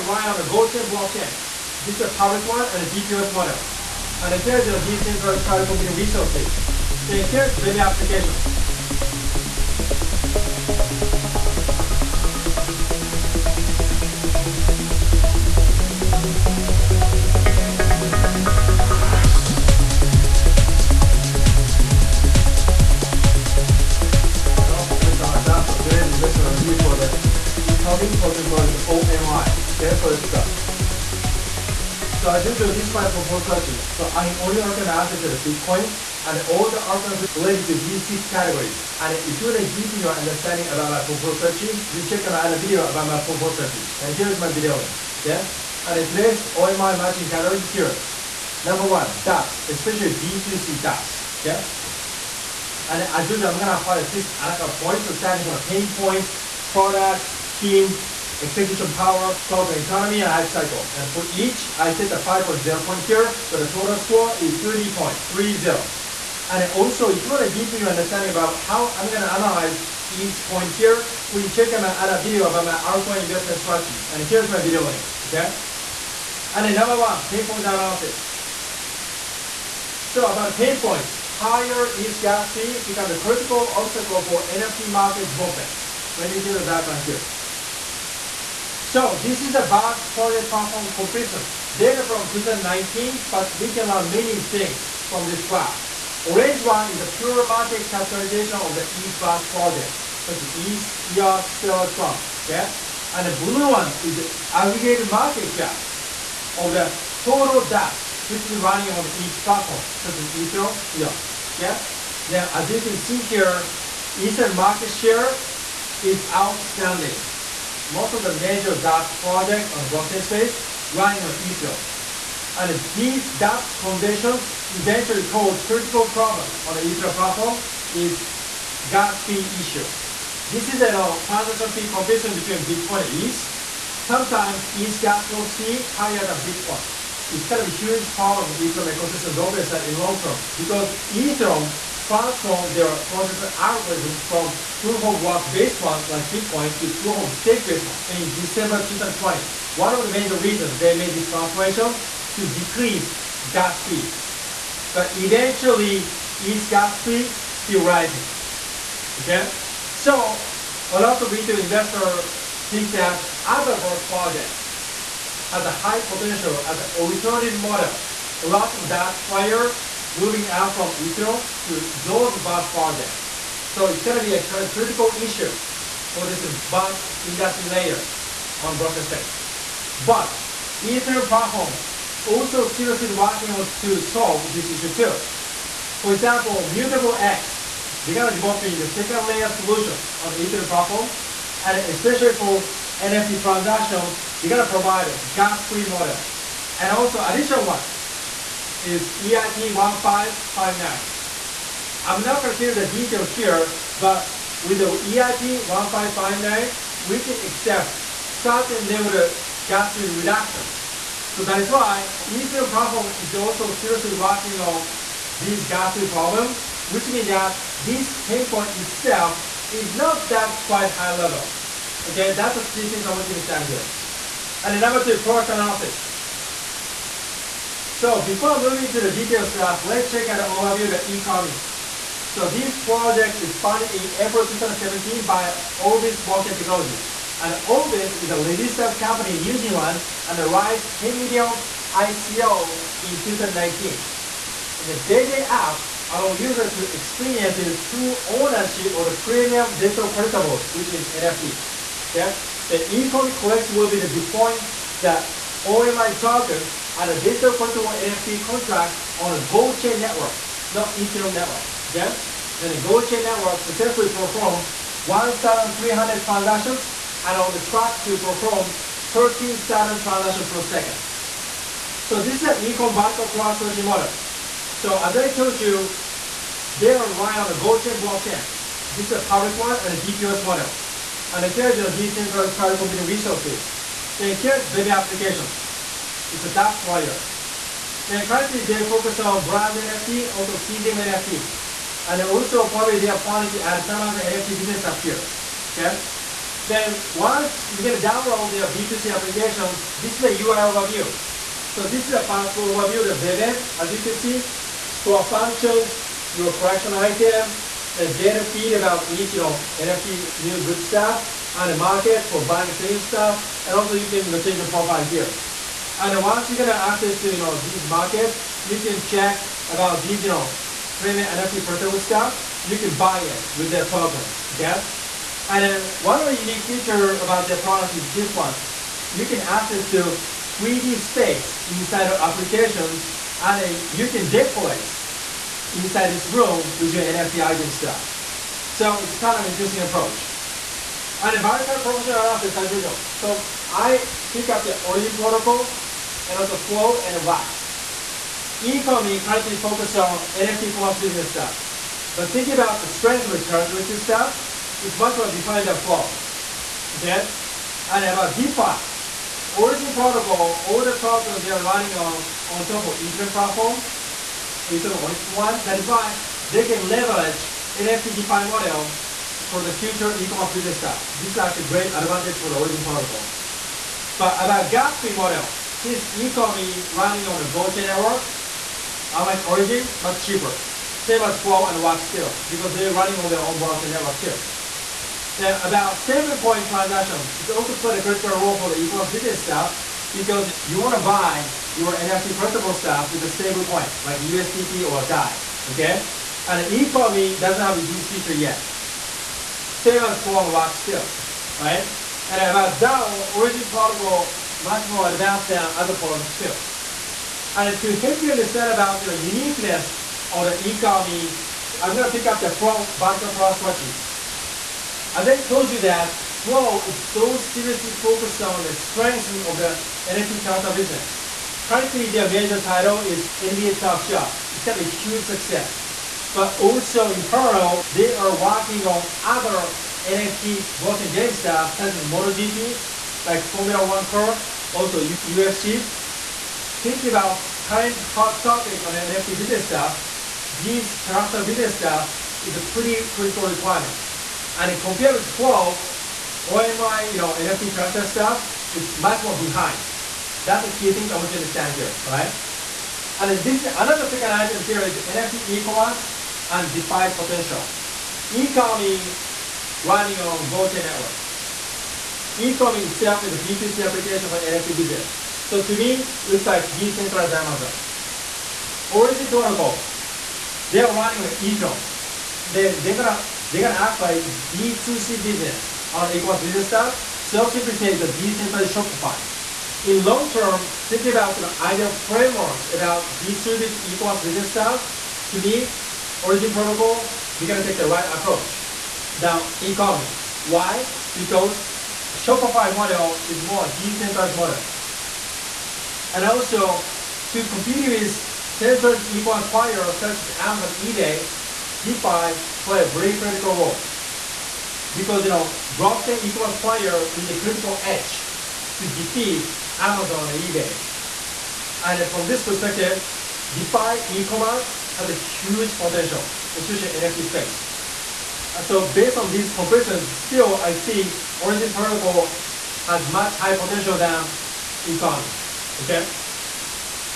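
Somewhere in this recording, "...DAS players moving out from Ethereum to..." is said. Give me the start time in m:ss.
2:48.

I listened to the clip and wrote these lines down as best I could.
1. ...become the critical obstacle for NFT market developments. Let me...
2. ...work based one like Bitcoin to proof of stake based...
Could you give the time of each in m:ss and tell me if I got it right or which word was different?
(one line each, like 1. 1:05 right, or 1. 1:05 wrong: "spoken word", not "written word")
1. 1:22 right
2. 2:25 right.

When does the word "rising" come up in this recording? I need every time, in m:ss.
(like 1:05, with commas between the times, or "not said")
2:37.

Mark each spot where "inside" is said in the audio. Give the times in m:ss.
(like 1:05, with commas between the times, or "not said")
5:31, 5:35.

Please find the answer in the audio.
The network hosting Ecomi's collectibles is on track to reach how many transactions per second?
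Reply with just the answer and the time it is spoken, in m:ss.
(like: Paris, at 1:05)
13,000, at 4:28.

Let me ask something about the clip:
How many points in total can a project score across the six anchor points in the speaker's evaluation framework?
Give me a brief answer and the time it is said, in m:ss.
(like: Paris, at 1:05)
30, at 1:03.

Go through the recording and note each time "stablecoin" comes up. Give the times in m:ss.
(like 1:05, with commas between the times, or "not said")
6:25, 6:33.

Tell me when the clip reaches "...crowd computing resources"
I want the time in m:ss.
4:42.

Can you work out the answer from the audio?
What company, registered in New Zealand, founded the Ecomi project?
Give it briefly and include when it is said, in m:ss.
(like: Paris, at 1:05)
Orbis Blockchain Technology, at 3:55.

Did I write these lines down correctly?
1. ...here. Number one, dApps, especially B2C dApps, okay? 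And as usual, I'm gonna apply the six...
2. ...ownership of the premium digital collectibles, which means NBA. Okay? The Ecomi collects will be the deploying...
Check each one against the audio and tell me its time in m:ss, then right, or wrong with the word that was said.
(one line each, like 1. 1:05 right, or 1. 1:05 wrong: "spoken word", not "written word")
1. 0:47 right
2. 4:08 wrong: "NFT", not "NBA".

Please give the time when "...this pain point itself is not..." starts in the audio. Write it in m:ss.
3:37.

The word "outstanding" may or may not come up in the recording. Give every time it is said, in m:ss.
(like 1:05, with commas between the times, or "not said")
1:56.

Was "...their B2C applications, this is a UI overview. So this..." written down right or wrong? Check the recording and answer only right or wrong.
right.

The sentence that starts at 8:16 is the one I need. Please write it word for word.
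And also, to compete with centralized e-commerce players such as Amazon, eBay, DeFi play a very critical role.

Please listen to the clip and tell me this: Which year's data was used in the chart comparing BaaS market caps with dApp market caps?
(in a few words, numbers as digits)
2019.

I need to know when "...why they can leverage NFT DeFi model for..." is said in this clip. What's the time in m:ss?
6:05.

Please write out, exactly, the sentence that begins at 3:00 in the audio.
But Ethereum platform also seriously working on to solve this issue too.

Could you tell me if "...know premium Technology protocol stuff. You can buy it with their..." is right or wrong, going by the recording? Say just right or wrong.
wrong.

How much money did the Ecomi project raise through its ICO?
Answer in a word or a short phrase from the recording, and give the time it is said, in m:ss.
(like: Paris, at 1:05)
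10 million, at 4:00.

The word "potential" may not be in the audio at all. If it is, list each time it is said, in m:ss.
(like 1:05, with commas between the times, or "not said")
2:46, 7:37, 8:35, 8:43.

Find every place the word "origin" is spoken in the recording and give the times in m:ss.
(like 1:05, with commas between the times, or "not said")
5:44, 5:59, 6:12, 6:19, 6:43, 7:48, 8:06, 8:41.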